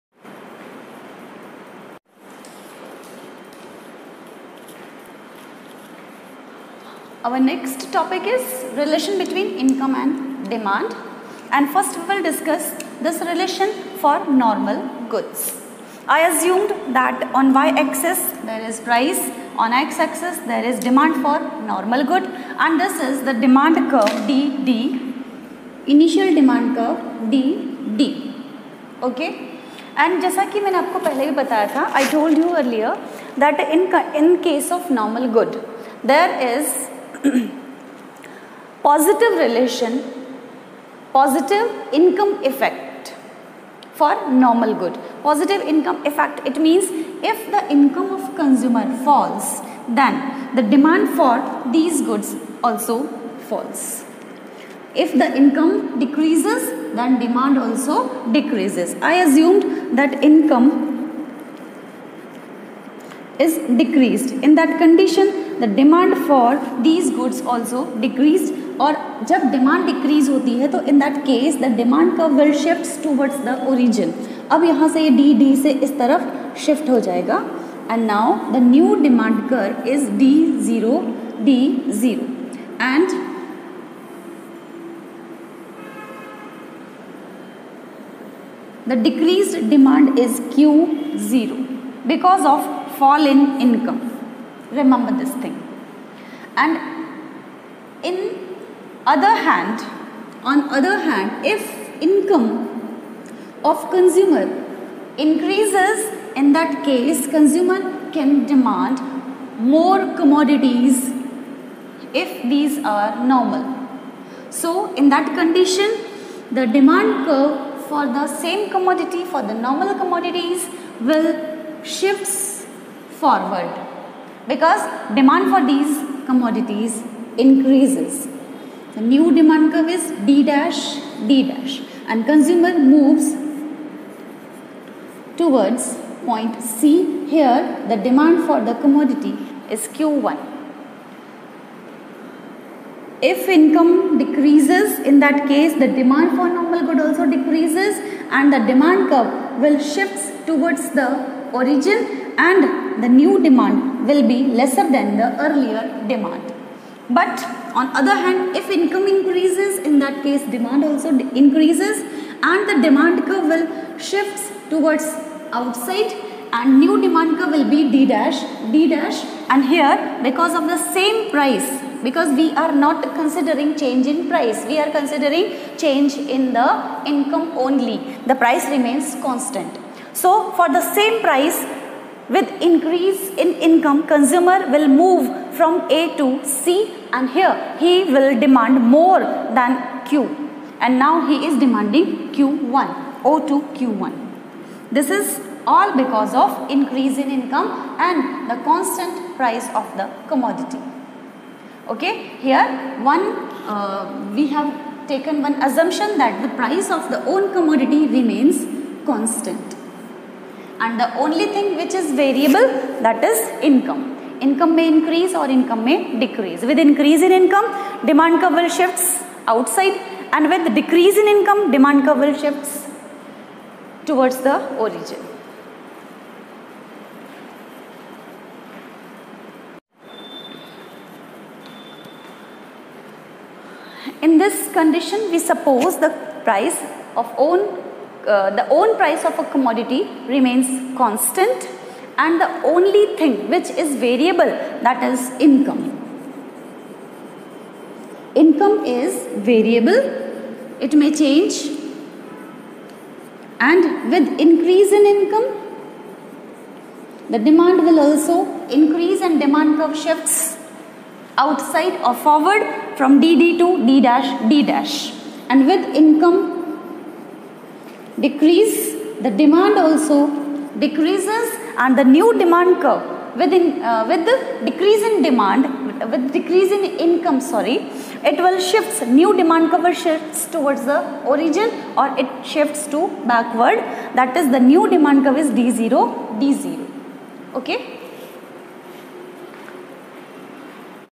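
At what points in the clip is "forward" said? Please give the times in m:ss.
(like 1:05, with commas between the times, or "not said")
2:03, 4:22.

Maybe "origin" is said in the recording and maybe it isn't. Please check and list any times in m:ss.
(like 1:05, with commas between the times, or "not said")
2:31, 3:44, 4:41.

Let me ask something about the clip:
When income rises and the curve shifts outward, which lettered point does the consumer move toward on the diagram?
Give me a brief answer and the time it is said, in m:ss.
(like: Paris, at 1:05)
Point C, at 2:16.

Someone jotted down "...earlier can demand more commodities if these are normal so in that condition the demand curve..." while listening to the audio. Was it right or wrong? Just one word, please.
wrong.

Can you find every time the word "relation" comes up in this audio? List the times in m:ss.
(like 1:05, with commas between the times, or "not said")
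0:08, 0:13, 0:39.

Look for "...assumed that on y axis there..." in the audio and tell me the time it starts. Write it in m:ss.
0:16.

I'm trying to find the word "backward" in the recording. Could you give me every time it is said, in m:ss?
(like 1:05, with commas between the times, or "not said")
4:43.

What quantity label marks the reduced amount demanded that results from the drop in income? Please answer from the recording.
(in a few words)
Q0.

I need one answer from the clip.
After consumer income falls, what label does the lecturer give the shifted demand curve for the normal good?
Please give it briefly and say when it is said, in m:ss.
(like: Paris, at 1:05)
D0 D0, at 1:20.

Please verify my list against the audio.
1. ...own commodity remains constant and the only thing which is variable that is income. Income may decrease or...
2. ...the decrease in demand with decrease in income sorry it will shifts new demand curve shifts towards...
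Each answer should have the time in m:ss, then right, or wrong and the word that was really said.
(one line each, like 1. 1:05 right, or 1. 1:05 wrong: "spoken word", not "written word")
1. 3:27 wrong: "increase", not "decrease"
2. 4:34 right.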